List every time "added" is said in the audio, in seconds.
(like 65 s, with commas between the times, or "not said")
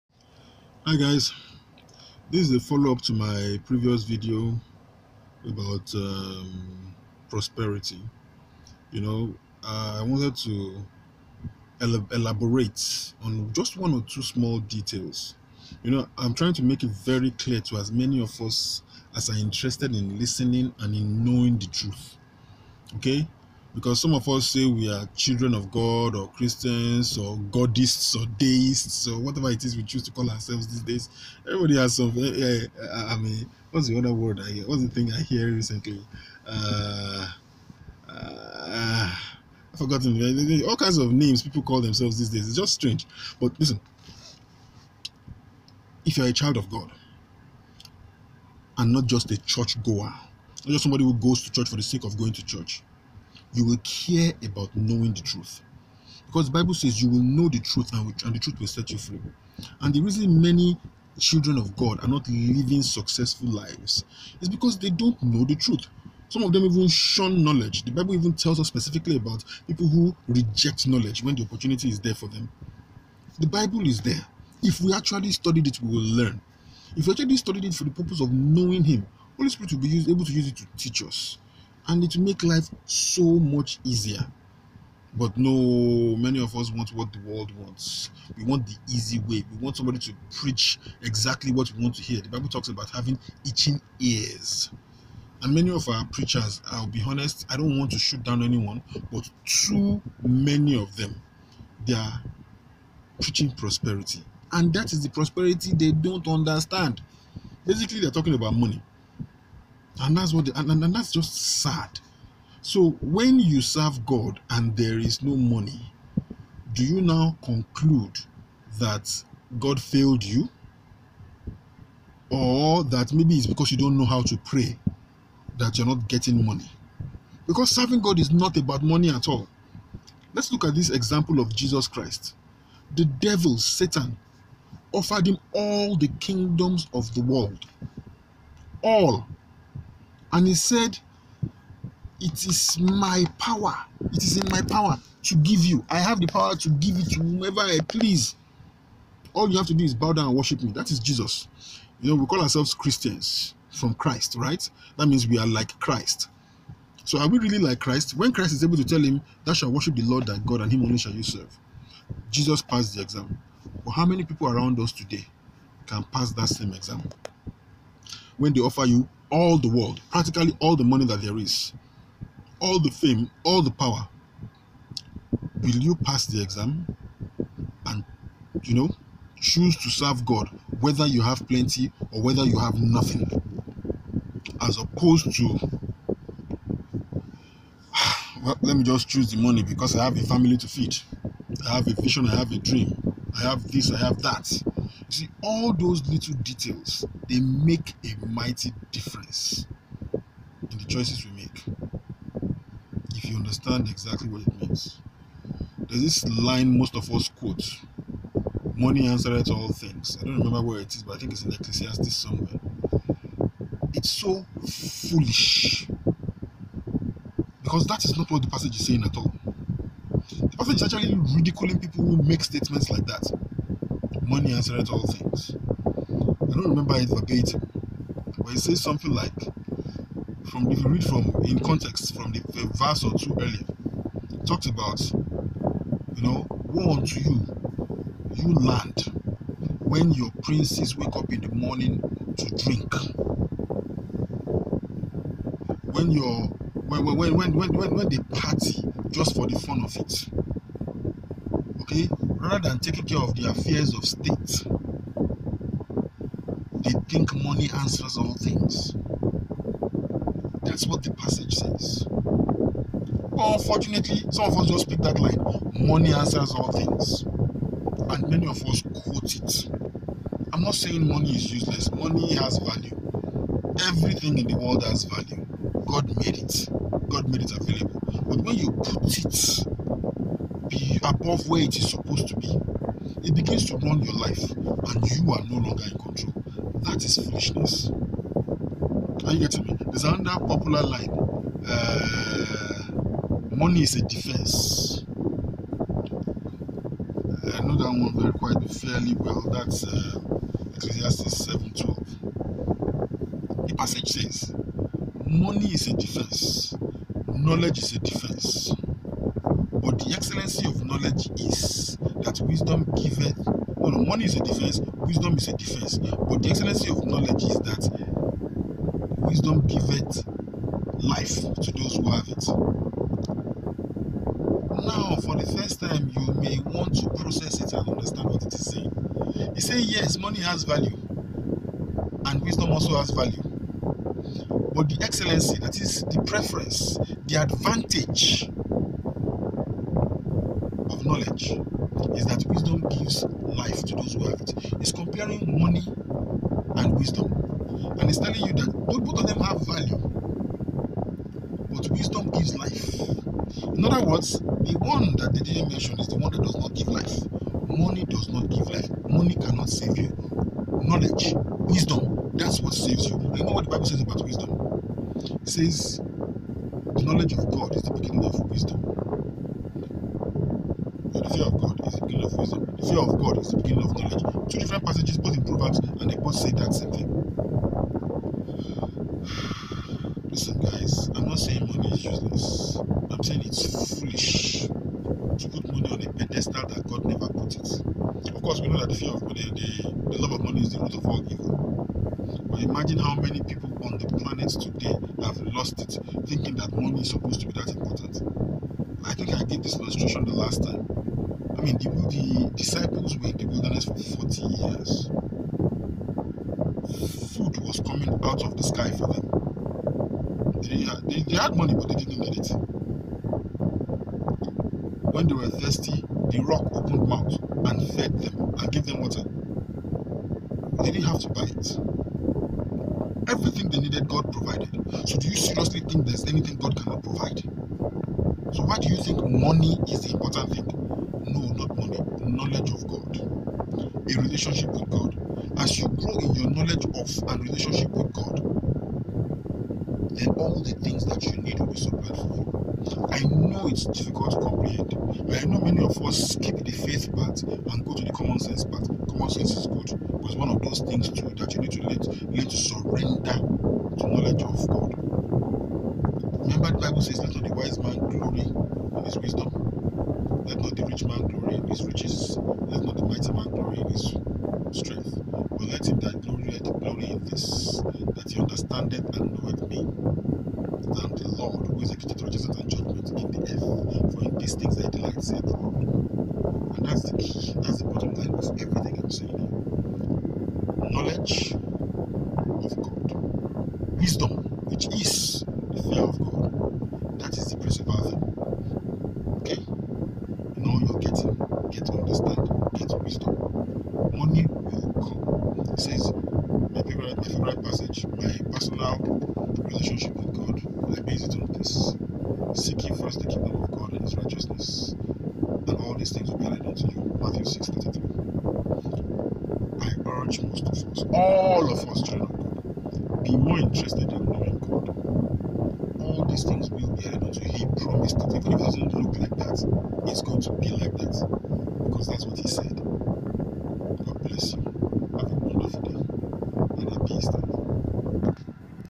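506 s, 517 s.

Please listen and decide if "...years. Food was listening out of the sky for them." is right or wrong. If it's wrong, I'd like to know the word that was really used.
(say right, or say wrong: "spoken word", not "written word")
wrong: "coming", not "listening".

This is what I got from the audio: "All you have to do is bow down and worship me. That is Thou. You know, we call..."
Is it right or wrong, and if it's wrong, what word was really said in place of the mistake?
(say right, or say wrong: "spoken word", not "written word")
wrong: "Jesus", not "Thou".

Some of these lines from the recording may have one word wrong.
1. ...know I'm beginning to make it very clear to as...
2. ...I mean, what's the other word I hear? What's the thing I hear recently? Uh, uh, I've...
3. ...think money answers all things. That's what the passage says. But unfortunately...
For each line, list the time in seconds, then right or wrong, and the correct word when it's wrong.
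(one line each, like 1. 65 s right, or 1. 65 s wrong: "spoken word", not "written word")
1. 15 s wrong: "trying", not "beginning"
2. 32 s right
3. 257 s right.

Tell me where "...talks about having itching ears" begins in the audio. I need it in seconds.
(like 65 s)
92 s.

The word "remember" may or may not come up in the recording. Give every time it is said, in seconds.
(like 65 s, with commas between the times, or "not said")
210 s, 226 s, 456 s.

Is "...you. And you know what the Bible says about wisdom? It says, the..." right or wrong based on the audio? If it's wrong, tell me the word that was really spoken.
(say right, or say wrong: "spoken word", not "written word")
right.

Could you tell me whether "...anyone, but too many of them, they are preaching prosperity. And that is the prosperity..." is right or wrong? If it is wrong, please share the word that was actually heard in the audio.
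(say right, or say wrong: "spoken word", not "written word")
right.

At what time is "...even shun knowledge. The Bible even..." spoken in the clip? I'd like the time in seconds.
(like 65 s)
66 s.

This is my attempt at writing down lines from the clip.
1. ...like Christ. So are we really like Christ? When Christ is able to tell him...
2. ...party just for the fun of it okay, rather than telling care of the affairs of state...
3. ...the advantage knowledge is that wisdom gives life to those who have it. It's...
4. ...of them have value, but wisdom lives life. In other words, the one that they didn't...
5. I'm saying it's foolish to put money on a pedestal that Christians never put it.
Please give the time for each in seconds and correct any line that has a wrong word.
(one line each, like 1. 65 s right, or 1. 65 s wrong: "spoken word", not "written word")
1. 155 s right
2. 248 s wrong: "taking", not "telling"
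3. 337 s right
4. 349 s wrong: "gives", not "lives"
5. 383 s wrong: "God", not "Christians".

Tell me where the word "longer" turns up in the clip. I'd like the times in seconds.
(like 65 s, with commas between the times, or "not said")
285 s.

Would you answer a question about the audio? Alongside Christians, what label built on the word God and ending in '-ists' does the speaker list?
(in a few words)
Godists.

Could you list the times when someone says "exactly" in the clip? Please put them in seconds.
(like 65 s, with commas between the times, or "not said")
91 s, 203 s.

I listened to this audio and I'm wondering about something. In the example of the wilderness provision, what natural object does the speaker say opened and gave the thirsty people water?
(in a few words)
the rock.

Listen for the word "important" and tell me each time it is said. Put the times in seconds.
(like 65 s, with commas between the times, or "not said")
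397 s, 430 s.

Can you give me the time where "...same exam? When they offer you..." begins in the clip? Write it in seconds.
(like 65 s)
166 s.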